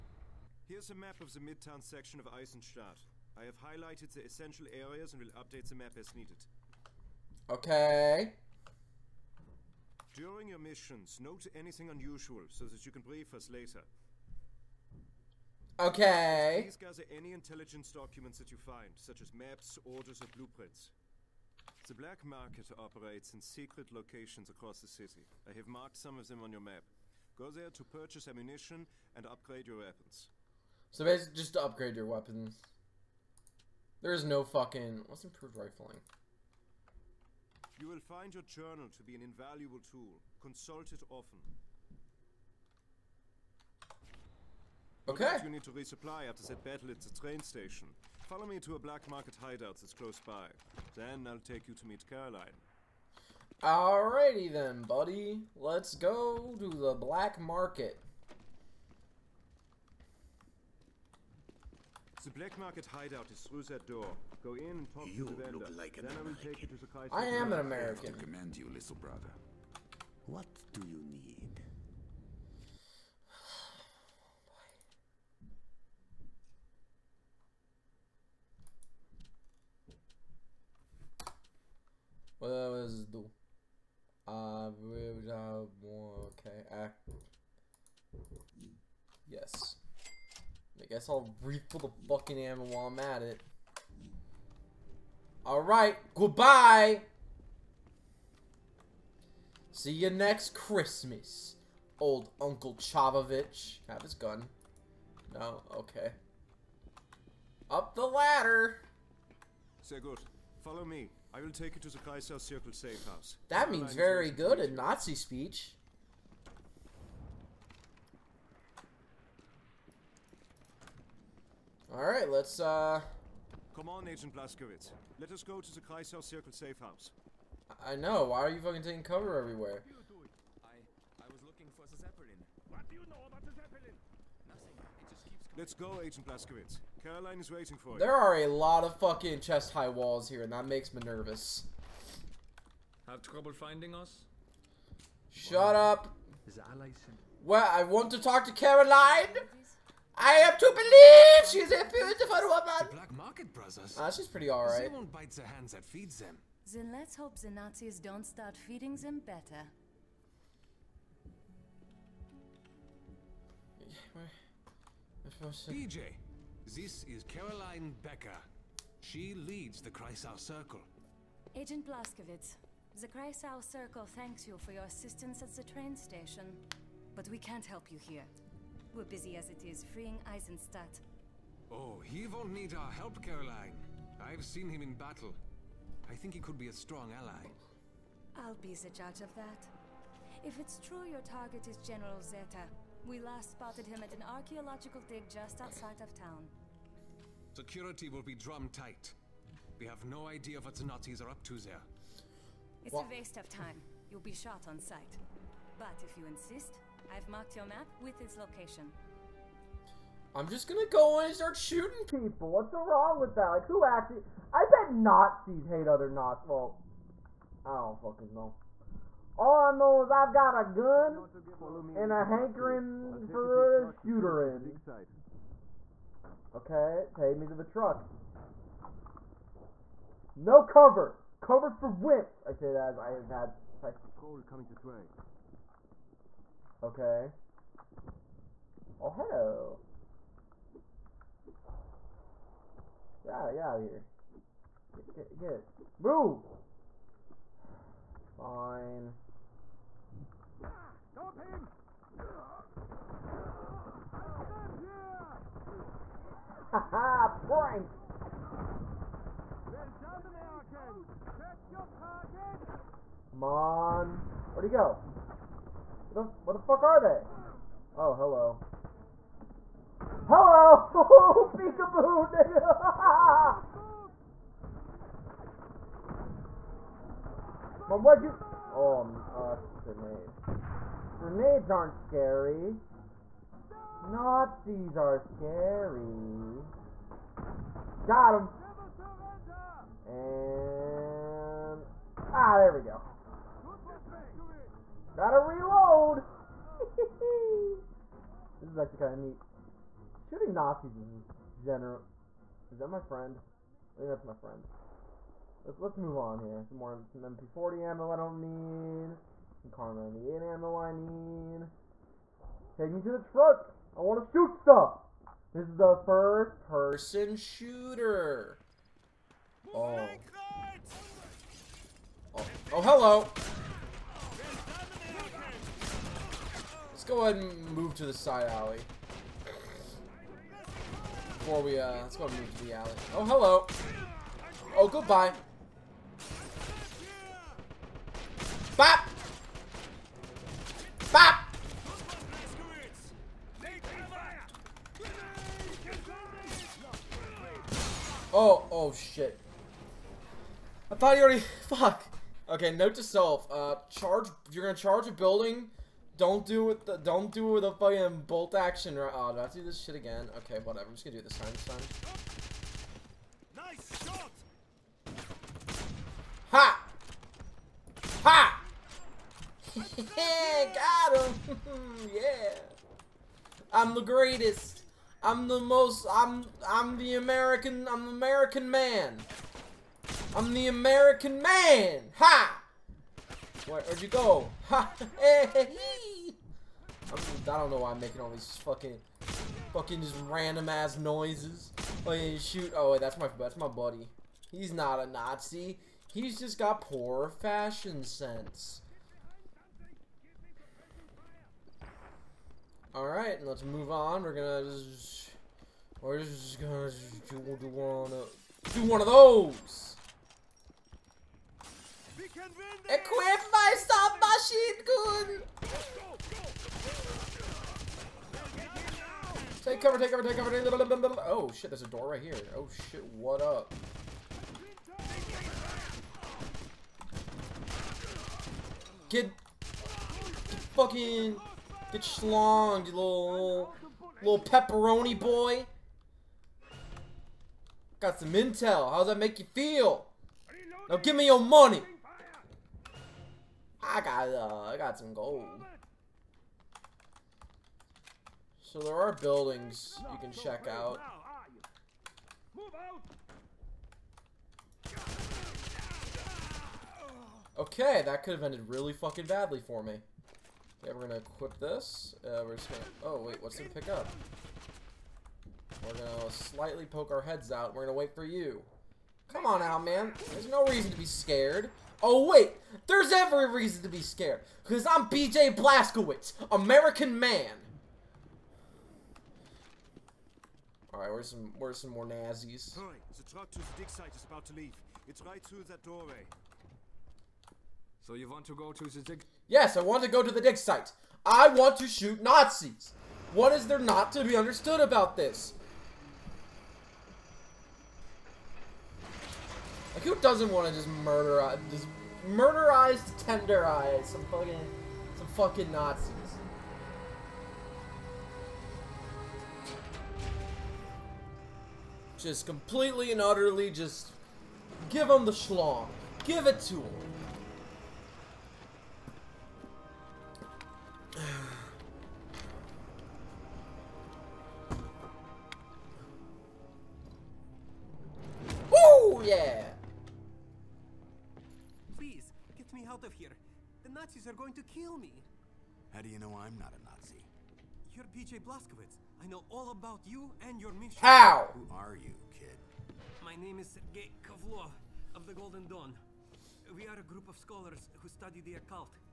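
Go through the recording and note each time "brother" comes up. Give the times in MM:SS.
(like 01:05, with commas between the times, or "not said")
01:08, 02:33.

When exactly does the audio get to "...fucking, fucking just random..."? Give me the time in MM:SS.
06:28.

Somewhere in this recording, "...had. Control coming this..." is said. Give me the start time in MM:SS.
03:53.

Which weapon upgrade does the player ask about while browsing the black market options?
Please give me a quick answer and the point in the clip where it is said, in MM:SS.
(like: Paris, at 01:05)
Improved rifling, at 00:35.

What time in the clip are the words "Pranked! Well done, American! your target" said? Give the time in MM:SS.
04:17.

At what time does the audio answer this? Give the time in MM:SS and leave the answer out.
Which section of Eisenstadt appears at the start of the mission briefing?
00:01.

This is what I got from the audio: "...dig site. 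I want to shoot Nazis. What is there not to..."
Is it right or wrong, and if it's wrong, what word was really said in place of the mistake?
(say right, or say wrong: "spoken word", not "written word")
right.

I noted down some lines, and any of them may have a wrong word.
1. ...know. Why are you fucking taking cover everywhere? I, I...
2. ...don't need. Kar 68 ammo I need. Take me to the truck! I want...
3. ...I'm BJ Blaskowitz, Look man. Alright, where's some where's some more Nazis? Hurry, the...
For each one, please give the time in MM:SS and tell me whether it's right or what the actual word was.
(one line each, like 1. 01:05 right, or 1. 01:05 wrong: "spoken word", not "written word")
1. 02:07 right
2. 05:08 wrong: "98", not "68"
3. 07:54 wrong: "American", not "Look".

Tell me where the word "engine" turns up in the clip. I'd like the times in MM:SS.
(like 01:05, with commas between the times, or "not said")
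not said.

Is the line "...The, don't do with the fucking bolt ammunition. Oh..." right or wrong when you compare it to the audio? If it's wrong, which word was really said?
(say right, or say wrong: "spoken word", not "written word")
wrong: "action", not "ammunition".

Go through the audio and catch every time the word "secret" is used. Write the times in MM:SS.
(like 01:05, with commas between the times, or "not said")
00:23.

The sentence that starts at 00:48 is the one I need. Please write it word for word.
Follow me to a black market hideout that's close by.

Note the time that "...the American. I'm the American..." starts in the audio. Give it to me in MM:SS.
06:16.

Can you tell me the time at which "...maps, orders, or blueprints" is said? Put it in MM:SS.
00:19.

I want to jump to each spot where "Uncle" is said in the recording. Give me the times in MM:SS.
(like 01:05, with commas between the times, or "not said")
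01:42.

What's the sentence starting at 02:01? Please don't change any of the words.
Alright, let's uh Come on, Agent Blaskowitz.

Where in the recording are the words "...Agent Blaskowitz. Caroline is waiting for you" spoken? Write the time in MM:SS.
02:16.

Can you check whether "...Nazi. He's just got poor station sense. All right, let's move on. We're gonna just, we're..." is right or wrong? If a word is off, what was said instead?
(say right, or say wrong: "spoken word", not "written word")
wrong: "fashion", not "station".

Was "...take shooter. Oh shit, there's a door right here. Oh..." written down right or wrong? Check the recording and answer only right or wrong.
wrong.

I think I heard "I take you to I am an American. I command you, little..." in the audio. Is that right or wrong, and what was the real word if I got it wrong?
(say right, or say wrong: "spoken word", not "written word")
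right.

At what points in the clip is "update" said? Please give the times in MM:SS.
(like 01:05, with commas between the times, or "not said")
00:05.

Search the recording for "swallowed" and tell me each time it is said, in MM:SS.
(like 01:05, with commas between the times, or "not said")
not said.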